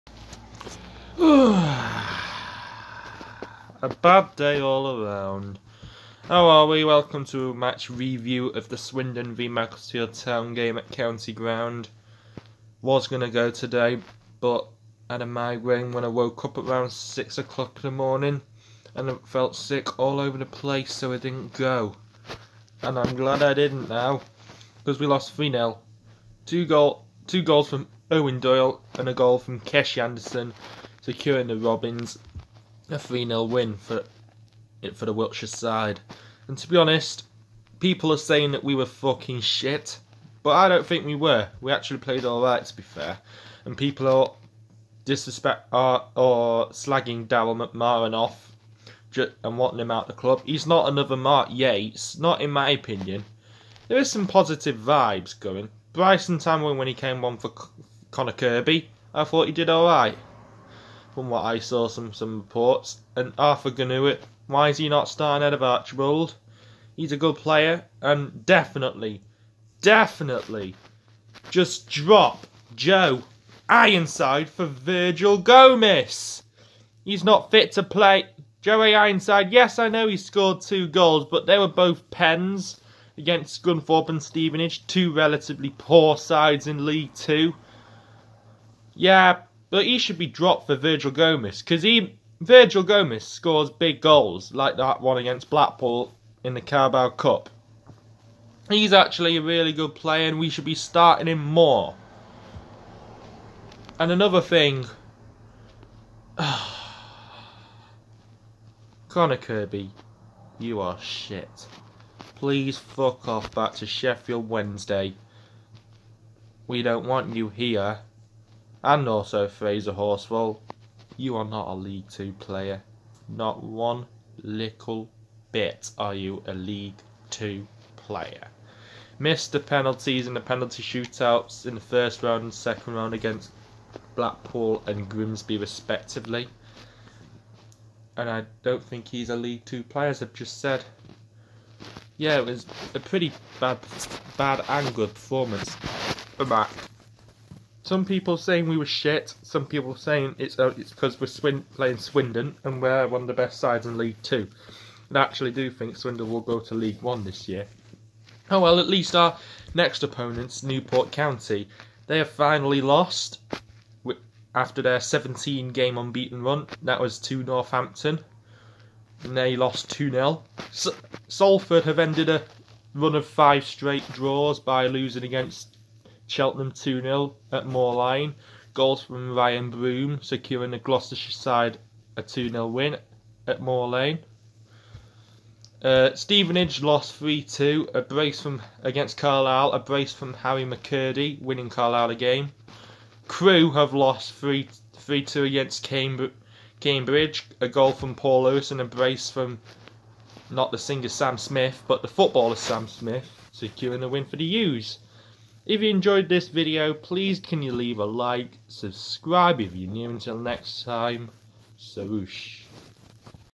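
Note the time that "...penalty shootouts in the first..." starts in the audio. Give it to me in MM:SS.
02:10.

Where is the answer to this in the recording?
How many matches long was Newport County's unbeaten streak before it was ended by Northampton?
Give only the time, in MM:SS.
02:45.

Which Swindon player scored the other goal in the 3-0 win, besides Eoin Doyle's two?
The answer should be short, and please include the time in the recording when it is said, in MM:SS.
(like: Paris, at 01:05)
Kesh Anderson, at 00:29.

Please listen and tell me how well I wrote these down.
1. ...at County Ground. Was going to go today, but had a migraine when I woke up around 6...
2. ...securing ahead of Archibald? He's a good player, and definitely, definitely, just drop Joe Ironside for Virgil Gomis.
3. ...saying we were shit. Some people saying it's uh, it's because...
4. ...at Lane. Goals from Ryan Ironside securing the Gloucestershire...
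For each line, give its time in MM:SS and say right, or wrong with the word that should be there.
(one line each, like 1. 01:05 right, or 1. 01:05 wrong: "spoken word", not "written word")
1. 00:10 right
2. 01:05 wrong: "starting", not "securing"
3. 02:28 right
4. 02:57 wrong: "Broom", not "Ironside".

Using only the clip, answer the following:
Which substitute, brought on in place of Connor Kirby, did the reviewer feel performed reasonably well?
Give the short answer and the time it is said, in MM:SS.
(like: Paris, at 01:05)
Bryson Tamwin, at 00:55.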